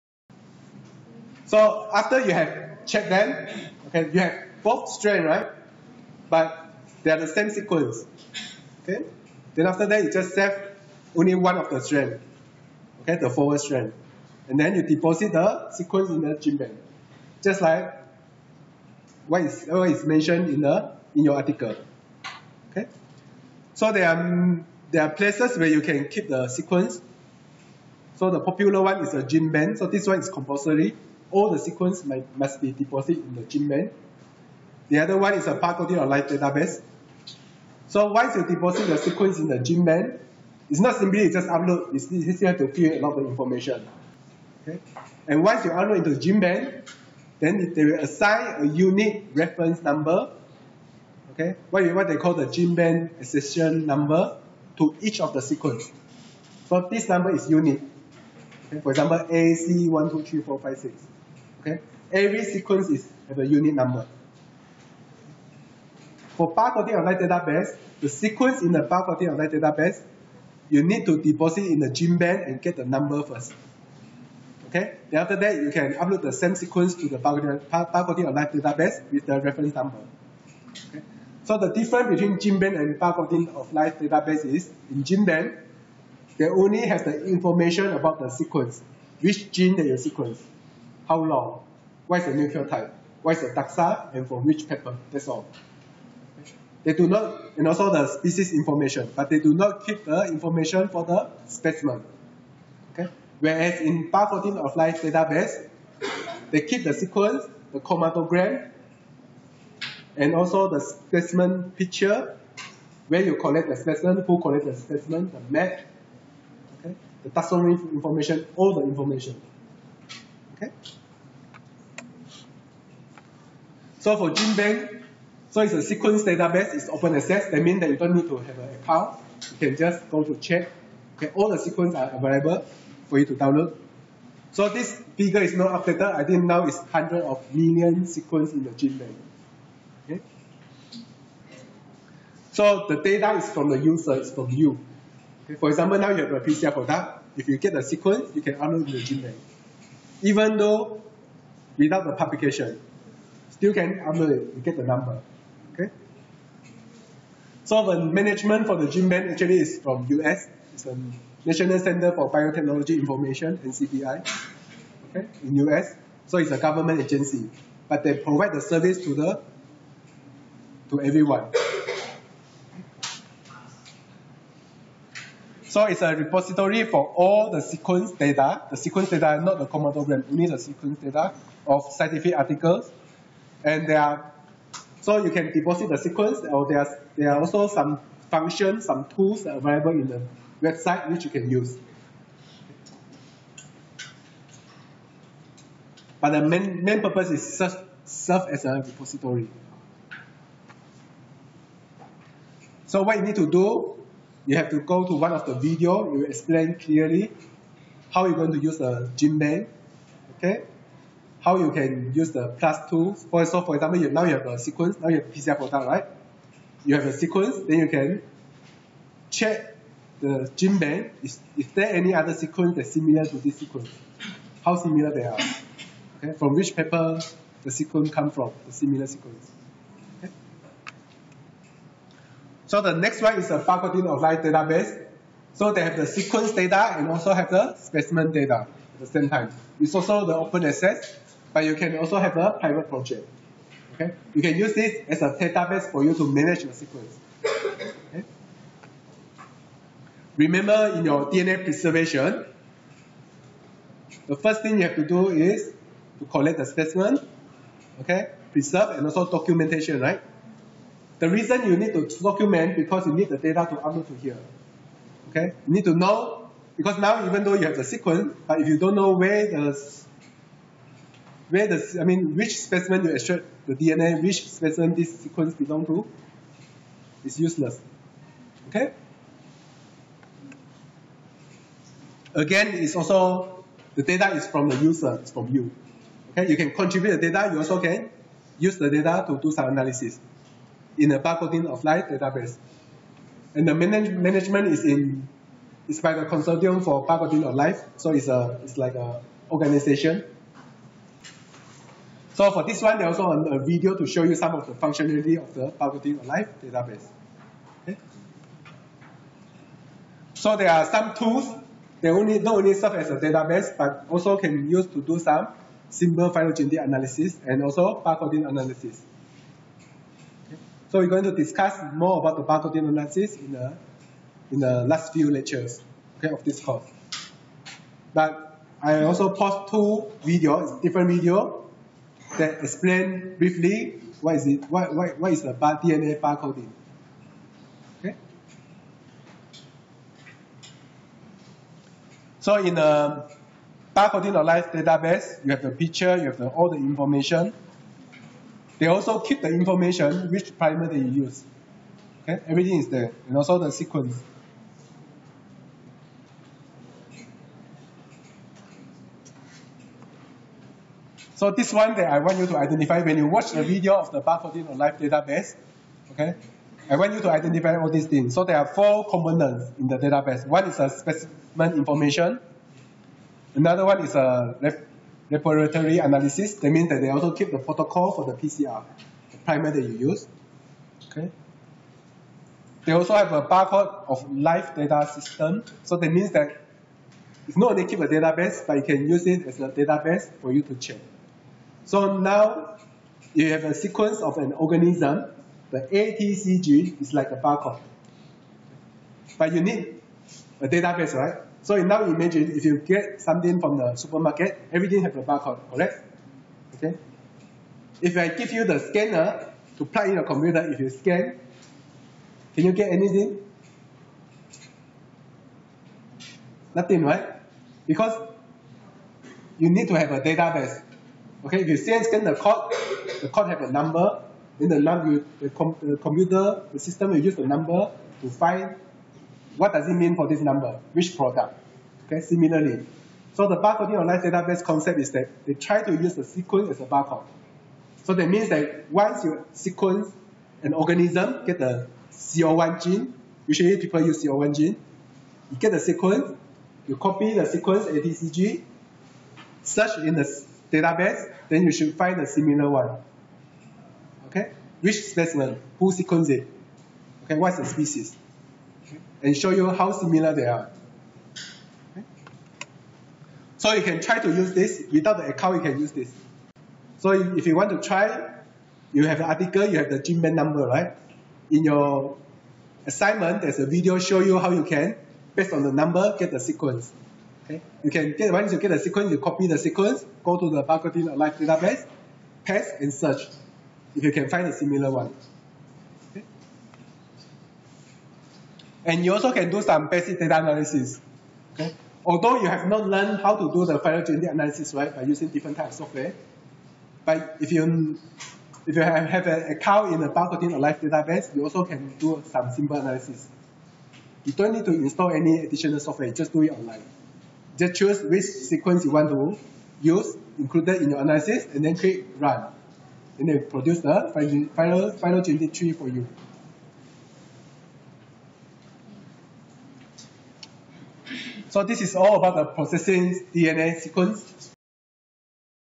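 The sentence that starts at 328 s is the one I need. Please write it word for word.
But I also post two videos, different videos that explain briefly what is it, what, what, what is the bar, DNA barcoding.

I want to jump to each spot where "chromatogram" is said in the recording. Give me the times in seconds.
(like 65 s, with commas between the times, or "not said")
107 s, 179 s.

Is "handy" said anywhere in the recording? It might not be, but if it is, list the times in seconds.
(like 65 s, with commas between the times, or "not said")
not said.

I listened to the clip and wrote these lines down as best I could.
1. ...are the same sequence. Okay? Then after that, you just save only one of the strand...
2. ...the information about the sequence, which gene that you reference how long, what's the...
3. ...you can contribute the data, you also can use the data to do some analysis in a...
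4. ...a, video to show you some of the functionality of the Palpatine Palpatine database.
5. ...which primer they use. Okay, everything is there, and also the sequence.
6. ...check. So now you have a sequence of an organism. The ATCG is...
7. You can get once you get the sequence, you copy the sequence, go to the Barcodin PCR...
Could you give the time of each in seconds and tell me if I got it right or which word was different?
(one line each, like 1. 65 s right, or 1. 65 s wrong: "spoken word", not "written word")
1. 7 s right
2. 87 s wrong: "sequence", not "reference"
3. 286 s right
4. 303 s wrong: "Alive", not "Palpatine"
5. 350 s right
6. 390 s right
7. 477 s wrong: "Alive", not "PCR".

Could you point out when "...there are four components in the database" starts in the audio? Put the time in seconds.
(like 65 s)
368 s.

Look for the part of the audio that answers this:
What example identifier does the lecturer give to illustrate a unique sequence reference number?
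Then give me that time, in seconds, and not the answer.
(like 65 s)
59 s.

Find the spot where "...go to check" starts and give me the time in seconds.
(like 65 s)
130 s.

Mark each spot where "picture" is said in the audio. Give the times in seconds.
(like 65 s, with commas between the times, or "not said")
111 s, 345 s.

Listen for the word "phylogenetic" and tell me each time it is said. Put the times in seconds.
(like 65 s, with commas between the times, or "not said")
316 s, 493 s, 514 s.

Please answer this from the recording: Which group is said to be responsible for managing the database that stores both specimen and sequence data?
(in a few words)
Consortium for Barcoding of Life.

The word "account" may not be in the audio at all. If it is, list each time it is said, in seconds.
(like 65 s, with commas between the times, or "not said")
128 s, 465 s, 499 s.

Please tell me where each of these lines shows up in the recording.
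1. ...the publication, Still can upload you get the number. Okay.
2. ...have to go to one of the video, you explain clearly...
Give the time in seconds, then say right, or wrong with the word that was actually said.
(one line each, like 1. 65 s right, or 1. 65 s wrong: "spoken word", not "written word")
1. 152 s right
2. 204 s right.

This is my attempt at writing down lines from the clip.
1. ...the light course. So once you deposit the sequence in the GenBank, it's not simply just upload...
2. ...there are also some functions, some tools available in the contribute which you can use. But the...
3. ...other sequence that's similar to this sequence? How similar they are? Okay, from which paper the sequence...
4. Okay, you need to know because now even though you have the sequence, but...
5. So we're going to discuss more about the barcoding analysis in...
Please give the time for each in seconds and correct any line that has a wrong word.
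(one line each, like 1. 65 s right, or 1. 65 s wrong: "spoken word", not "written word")
1. 35 s wrong: "database", not "course"
2. 187 s wrong: "website", not "contribute"
3. 222 s right
4. 265 s right
5. 320 s right.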